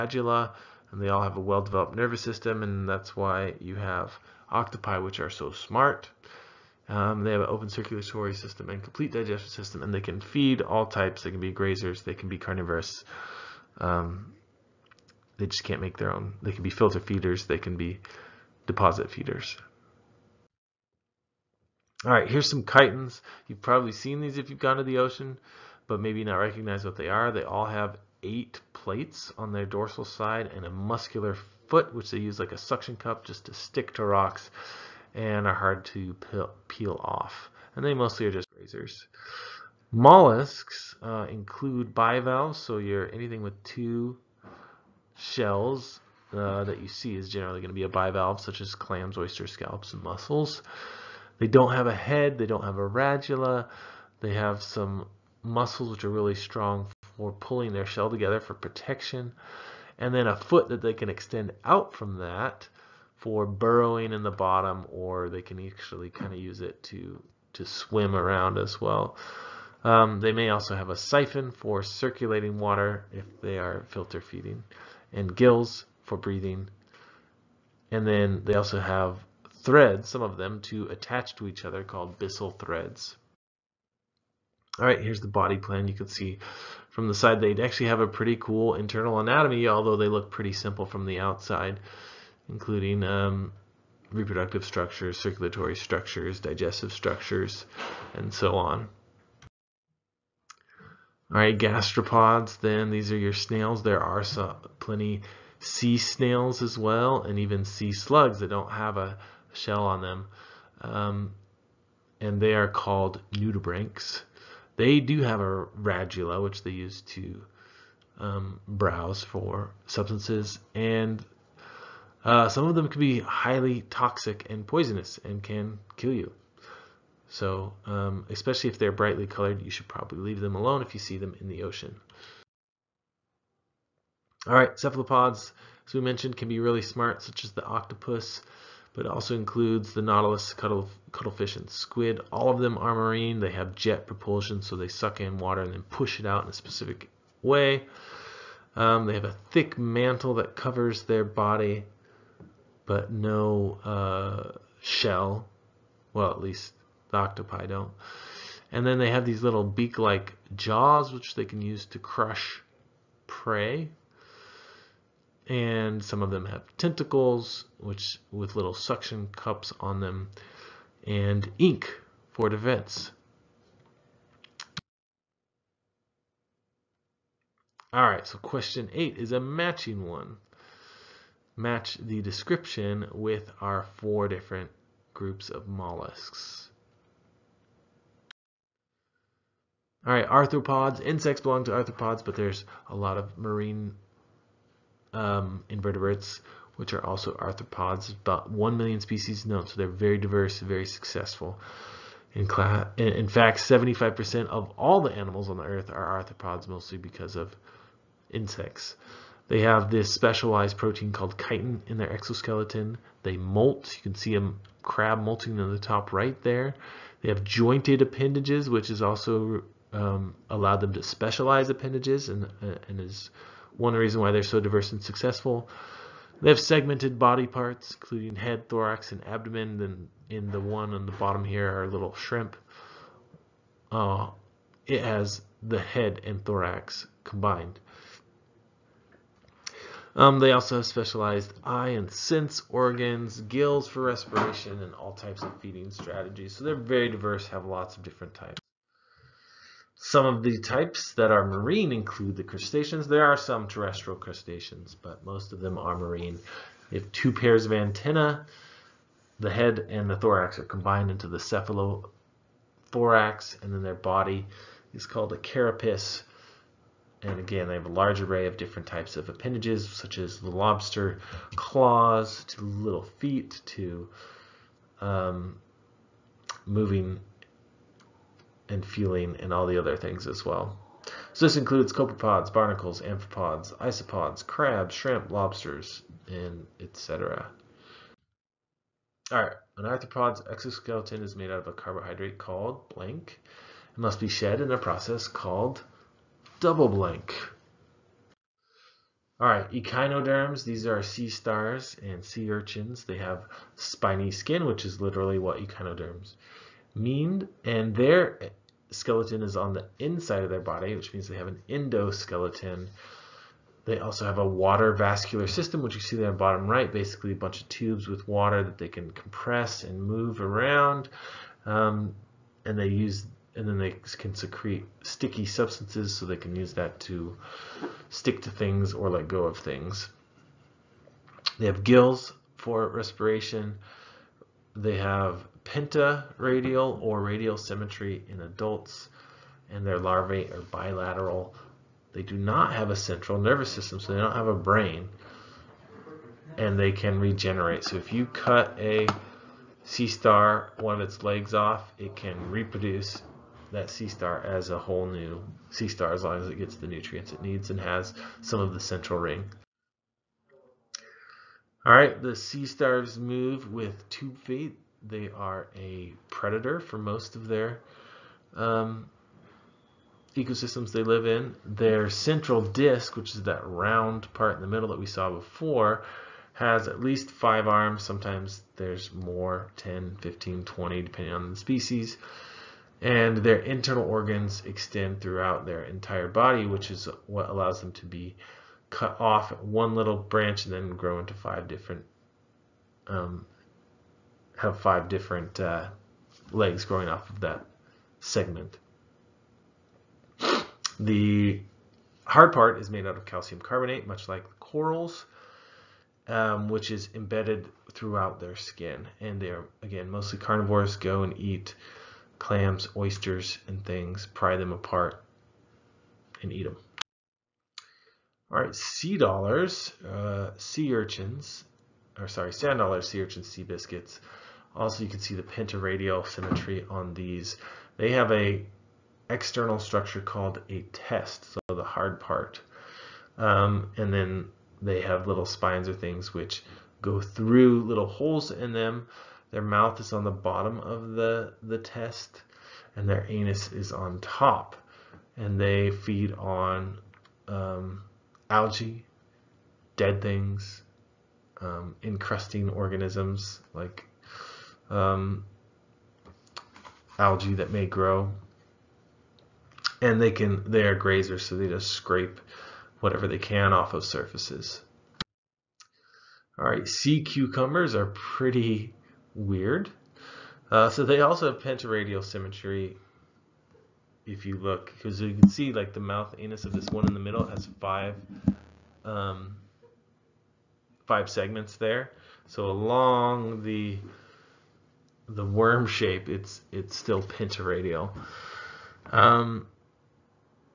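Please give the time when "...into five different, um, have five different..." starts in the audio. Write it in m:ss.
6:31.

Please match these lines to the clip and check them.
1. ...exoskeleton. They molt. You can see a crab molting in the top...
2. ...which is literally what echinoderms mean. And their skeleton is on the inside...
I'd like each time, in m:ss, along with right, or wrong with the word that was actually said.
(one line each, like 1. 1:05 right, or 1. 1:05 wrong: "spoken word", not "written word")
1. 3:32 right
2. 5:04 right.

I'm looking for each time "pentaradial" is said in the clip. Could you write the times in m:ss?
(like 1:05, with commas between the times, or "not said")
5:35, 7:05, 7:51, 8:07.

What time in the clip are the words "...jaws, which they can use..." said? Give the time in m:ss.
2:40.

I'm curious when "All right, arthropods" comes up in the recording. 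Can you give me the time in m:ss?
3:10.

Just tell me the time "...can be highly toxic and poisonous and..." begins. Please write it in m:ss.
2:02.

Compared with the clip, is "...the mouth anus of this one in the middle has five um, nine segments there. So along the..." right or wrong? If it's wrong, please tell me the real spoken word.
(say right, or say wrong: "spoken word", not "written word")
wrong: "five", not "nine".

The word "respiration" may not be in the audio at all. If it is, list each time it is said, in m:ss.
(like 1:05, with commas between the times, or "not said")
4:04, 5:32.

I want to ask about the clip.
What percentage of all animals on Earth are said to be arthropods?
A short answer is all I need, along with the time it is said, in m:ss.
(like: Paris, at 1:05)
75%, at 3:23.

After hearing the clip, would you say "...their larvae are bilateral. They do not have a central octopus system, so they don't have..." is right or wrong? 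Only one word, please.
wrong.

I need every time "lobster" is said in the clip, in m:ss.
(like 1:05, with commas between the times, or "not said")
4:30, 4:45.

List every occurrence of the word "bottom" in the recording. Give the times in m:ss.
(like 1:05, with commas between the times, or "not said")
1:04, 3:51, 5:16, 7:20.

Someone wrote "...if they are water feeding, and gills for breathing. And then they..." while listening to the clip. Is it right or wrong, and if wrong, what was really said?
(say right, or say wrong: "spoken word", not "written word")
wrong: "filter", not "water".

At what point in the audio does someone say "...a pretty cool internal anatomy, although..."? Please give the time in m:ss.
1:28.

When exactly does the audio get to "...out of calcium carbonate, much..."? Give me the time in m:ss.
6:43.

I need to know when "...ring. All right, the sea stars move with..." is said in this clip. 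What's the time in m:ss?
5:59.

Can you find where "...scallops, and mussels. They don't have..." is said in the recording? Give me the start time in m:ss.
0:49.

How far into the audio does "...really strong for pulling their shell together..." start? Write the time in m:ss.
0:56.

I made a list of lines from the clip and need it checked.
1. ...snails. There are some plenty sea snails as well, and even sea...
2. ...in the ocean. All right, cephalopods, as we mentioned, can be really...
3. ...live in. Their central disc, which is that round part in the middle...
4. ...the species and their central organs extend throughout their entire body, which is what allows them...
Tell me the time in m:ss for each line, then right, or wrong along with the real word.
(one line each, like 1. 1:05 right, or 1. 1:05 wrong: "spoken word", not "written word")
1. 1:43 right
2. 2:11 right
3. 6:11 right
4. 6:21 wrong: "internal", not "central".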